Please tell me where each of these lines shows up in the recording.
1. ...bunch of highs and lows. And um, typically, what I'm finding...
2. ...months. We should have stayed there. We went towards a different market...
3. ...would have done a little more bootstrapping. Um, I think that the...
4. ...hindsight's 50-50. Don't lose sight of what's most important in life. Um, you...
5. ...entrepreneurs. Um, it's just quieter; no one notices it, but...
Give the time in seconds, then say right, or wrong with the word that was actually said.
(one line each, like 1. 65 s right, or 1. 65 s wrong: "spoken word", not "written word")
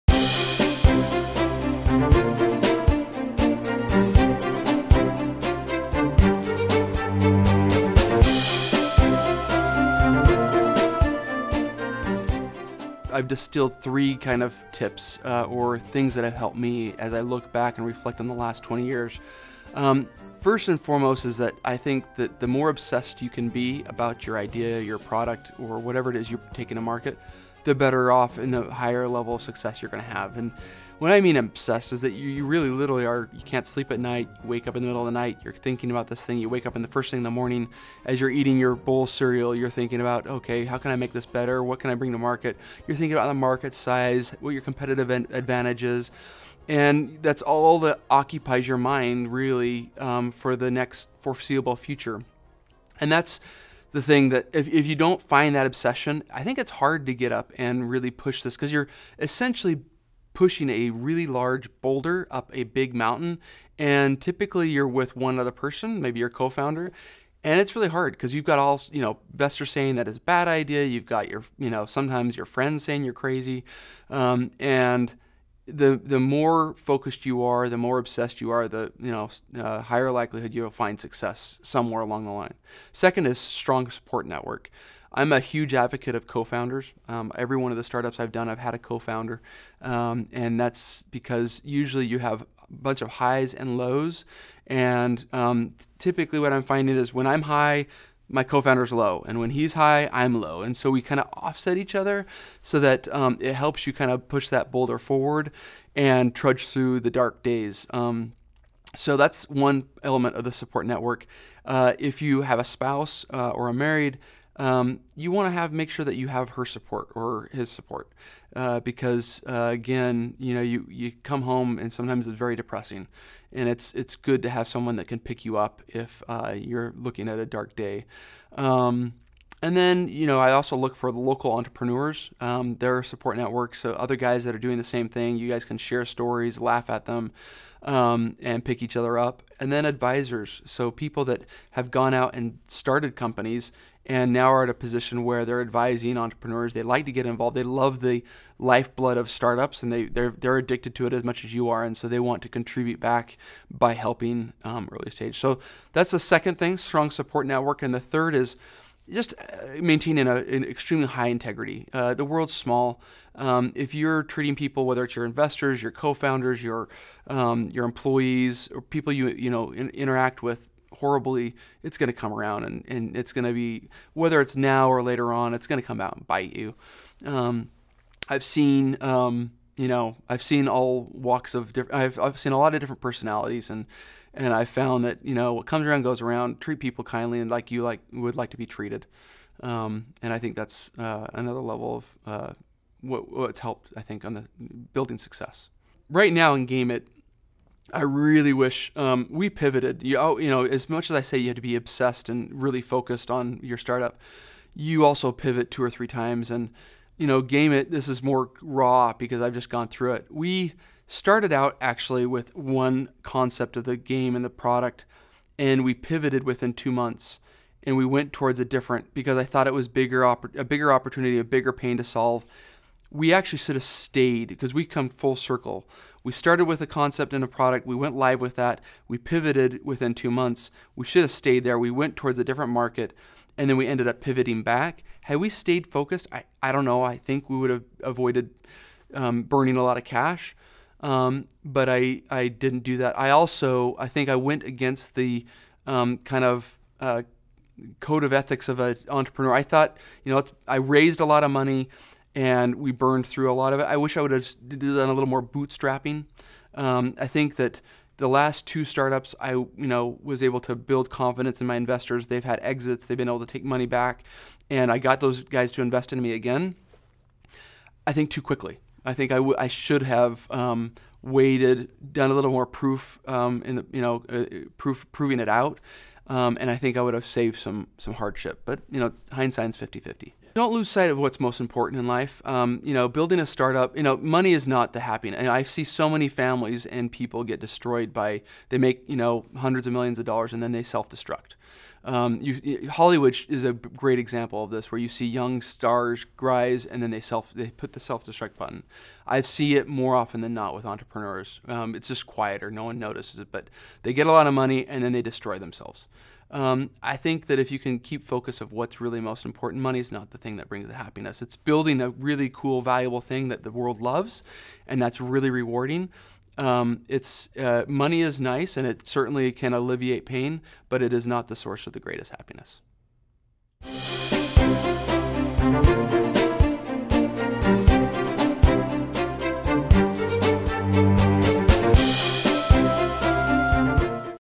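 1. 92 s right
2. 230 s right
3. 254 s right
4. 279 s right
5. 300 s right.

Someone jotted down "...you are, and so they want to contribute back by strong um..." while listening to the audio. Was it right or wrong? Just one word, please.
wrong.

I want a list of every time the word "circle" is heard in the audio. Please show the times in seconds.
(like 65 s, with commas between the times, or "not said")
225 s.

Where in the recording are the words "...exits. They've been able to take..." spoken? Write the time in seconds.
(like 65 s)
262 s.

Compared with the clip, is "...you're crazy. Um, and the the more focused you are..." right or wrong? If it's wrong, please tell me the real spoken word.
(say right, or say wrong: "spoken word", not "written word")
right.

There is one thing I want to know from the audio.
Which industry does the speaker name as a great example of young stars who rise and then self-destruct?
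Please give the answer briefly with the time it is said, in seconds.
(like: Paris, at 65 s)
Hollywood, at 292 s.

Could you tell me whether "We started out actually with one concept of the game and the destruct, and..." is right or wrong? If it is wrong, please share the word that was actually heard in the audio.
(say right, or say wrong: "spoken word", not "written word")
wrong: "product", not "destruct".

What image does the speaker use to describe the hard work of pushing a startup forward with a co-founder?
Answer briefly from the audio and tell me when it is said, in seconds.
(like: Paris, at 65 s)
a really large boulder, at 60 s.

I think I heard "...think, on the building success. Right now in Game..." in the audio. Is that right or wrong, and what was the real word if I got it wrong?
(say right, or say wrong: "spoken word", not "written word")
right.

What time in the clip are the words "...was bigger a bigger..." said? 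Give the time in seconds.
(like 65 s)
219 s.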